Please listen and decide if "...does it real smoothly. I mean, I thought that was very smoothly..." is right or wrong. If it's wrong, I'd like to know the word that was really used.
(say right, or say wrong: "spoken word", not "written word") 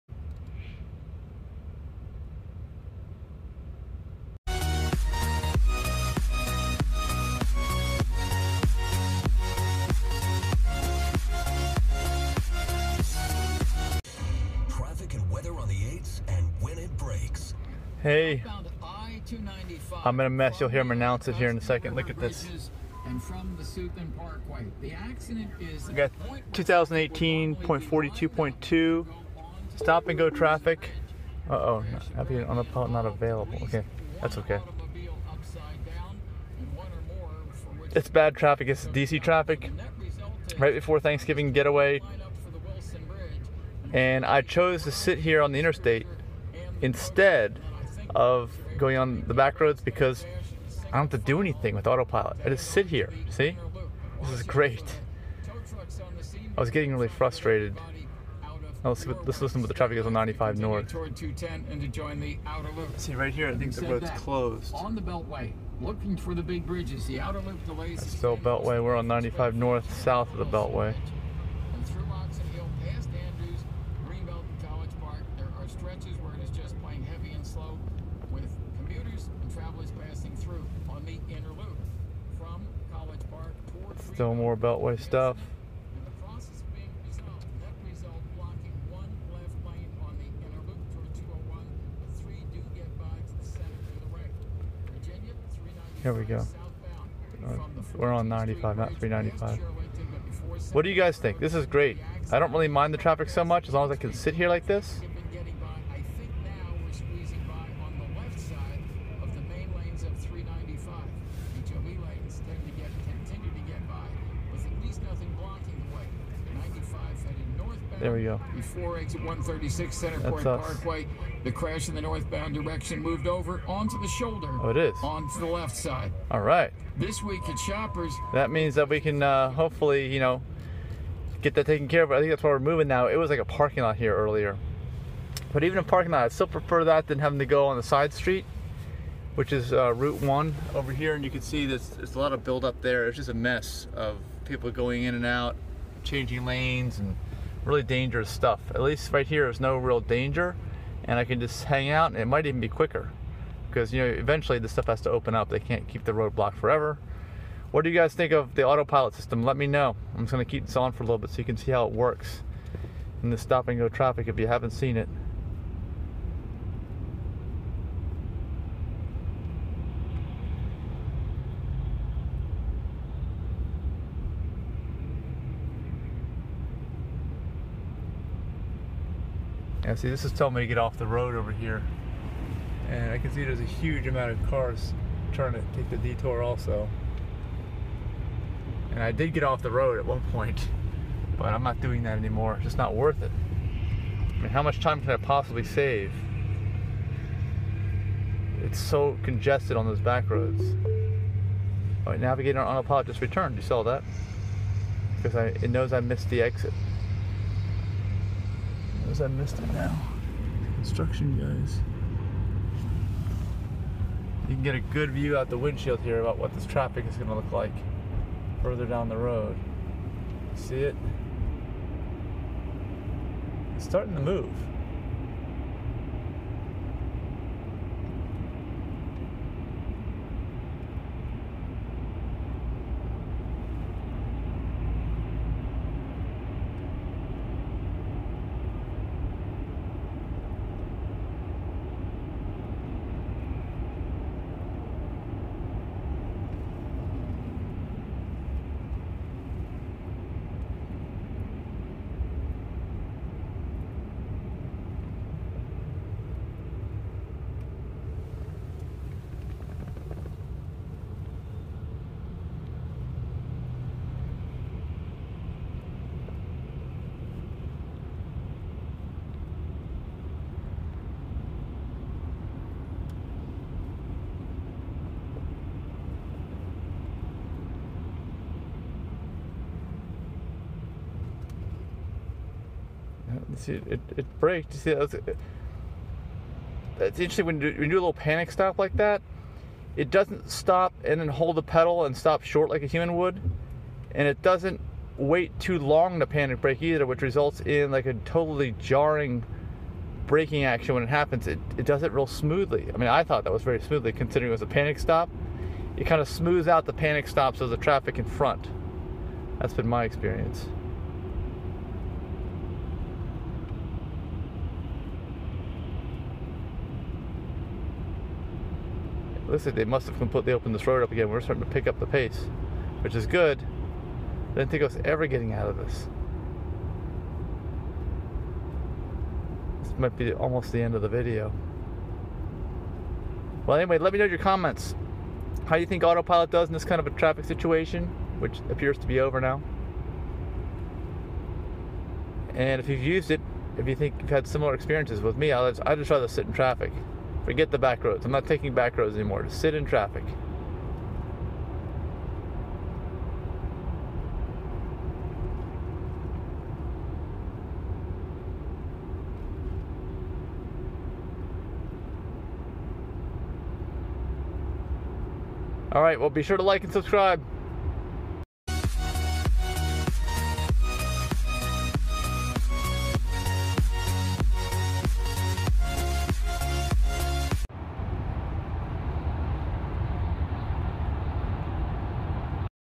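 right.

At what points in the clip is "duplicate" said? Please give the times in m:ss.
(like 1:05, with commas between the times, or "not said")
not said.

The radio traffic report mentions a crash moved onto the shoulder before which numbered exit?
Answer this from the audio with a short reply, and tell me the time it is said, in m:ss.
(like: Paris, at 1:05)
136, at 1:58.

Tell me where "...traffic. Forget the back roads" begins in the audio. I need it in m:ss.
5:46.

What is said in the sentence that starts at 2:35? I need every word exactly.
They can't keep the road blocked forever.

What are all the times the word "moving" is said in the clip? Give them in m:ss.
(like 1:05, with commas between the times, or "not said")
2:12.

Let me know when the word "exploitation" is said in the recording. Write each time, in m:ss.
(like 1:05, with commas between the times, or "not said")
not said.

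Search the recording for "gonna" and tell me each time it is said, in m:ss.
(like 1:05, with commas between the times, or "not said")
0:20, 2:40.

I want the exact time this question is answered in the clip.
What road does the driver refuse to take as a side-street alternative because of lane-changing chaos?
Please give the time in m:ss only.
2:19.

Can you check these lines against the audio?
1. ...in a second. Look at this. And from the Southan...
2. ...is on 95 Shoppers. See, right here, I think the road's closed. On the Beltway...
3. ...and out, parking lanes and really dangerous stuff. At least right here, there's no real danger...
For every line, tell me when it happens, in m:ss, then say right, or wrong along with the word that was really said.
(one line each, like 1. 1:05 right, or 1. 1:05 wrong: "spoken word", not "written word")
1. 0:21 right
2. 0:59 wrong: "North", not "Shoppers"
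3. 2:25 wrong: "changing", not "parking".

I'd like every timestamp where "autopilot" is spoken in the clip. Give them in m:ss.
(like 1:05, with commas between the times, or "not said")
0:51, 2:38, 3:22, 5:36.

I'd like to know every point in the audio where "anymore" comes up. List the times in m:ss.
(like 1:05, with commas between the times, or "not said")
3:12, 5:49.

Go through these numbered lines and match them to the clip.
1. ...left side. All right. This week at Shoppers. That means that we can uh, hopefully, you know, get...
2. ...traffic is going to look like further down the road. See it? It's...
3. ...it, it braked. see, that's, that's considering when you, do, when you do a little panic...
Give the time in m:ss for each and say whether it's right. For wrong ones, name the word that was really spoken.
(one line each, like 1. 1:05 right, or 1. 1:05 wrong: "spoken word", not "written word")
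1. 2:05 right
2. 3:36 right
3. 4:43 wrong: "interesting", not "considering".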